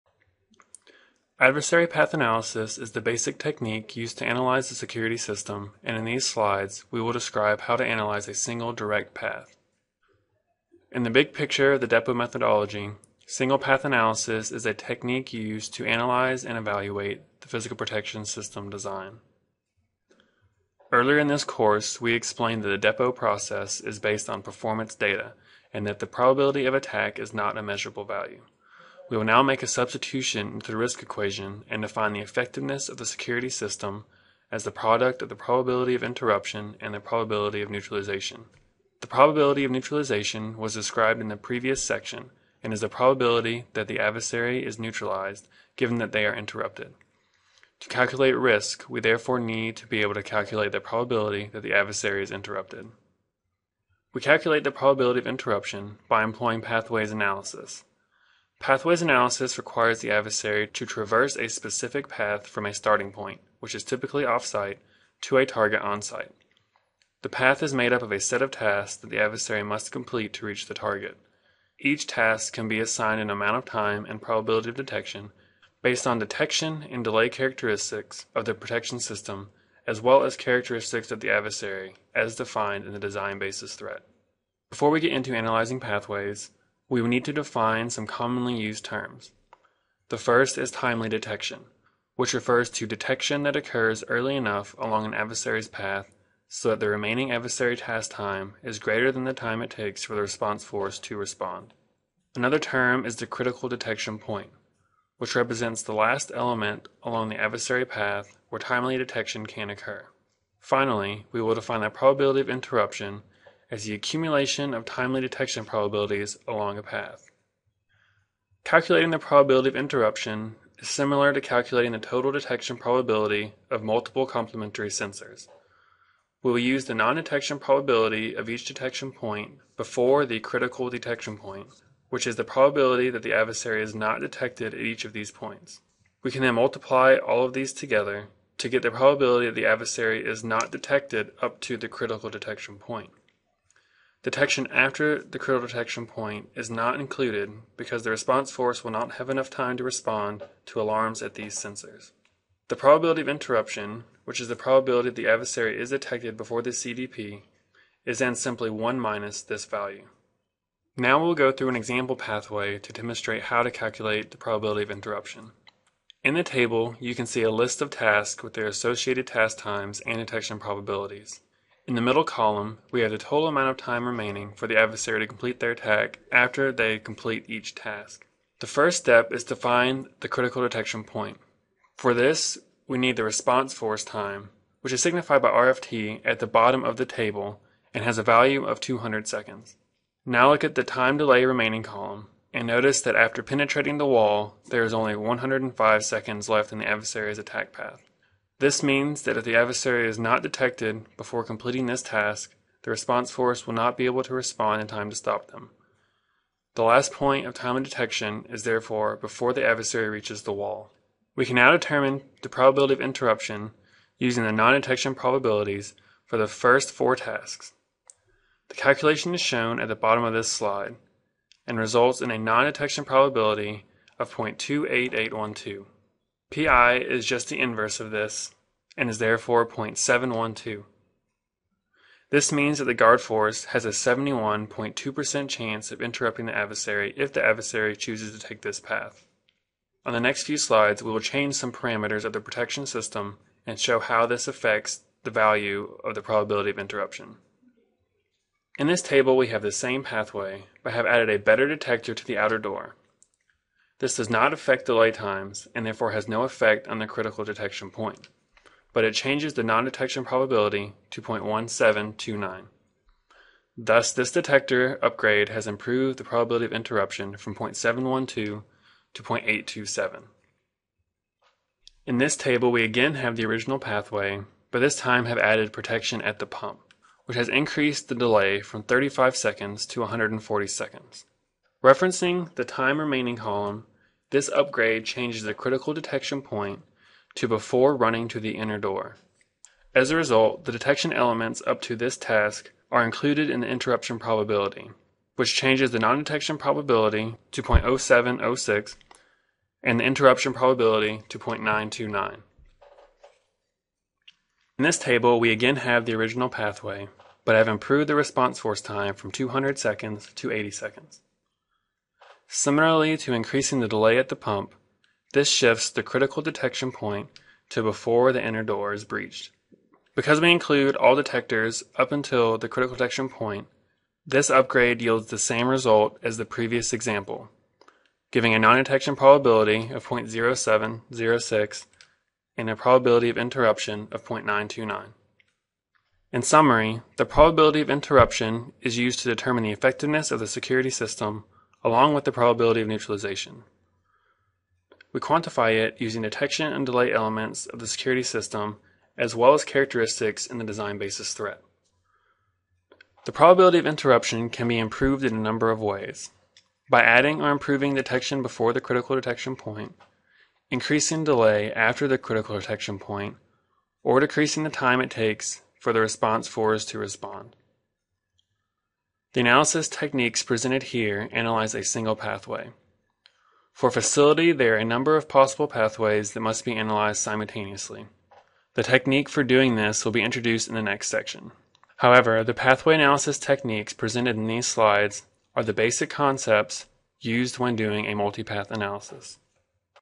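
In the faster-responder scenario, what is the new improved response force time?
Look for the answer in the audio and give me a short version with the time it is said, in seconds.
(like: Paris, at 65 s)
80 seconds, at 310 s.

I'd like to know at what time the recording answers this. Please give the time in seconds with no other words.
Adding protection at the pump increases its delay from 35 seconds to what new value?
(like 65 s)
279 s.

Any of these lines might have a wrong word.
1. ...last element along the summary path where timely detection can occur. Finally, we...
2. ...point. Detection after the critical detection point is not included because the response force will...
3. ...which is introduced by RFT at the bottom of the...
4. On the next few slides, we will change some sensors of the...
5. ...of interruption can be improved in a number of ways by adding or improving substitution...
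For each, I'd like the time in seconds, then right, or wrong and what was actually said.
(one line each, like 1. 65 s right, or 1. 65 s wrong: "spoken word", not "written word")
1. 105 s wrong: "adversary", not "summary"
2. 142 s right
3. 184 s wrong: "signified", not "introduced"
4. 240 s wrong: "parameters", not "sensors"
5. 353 s wrong: "detection", not "substitution".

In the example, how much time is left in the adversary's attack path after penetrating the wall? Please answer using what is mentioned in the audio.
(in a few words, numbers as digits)
105 seconds.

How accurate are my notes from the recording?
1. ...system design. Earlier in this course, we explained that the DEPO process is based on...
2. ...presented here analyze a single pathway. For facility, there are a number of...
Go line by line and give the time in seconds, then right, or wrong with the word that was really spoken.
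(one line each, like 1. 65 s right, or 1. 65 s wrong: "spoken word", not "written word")
1. 18 s right
2. 370 s right.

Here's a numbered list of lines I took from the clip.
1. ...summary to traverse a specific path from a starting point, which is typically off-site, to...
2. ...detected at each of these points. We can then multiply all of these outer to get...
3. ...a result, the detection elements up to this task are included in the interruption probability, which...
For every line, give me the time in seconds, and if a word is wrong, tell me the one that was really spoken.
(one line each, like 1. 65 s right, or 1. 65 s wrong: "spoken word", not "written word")
1. 60 s wrong: "adversary", not "summary"
2. 134 s wrong: "together", not "outer"
3. 290 s right.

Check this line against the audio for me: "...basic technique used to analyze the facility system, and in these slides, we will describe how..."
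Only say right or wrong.
wrong.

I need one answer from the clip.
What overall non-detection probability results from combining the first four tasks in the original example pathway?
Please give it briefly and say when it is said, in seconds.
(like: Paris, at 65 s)
0.28812, at 224 s.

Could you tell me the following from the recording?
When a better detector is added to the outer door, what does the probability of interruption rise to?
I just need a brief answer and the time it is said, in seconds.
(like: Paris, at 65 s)
0.827, at 269 s.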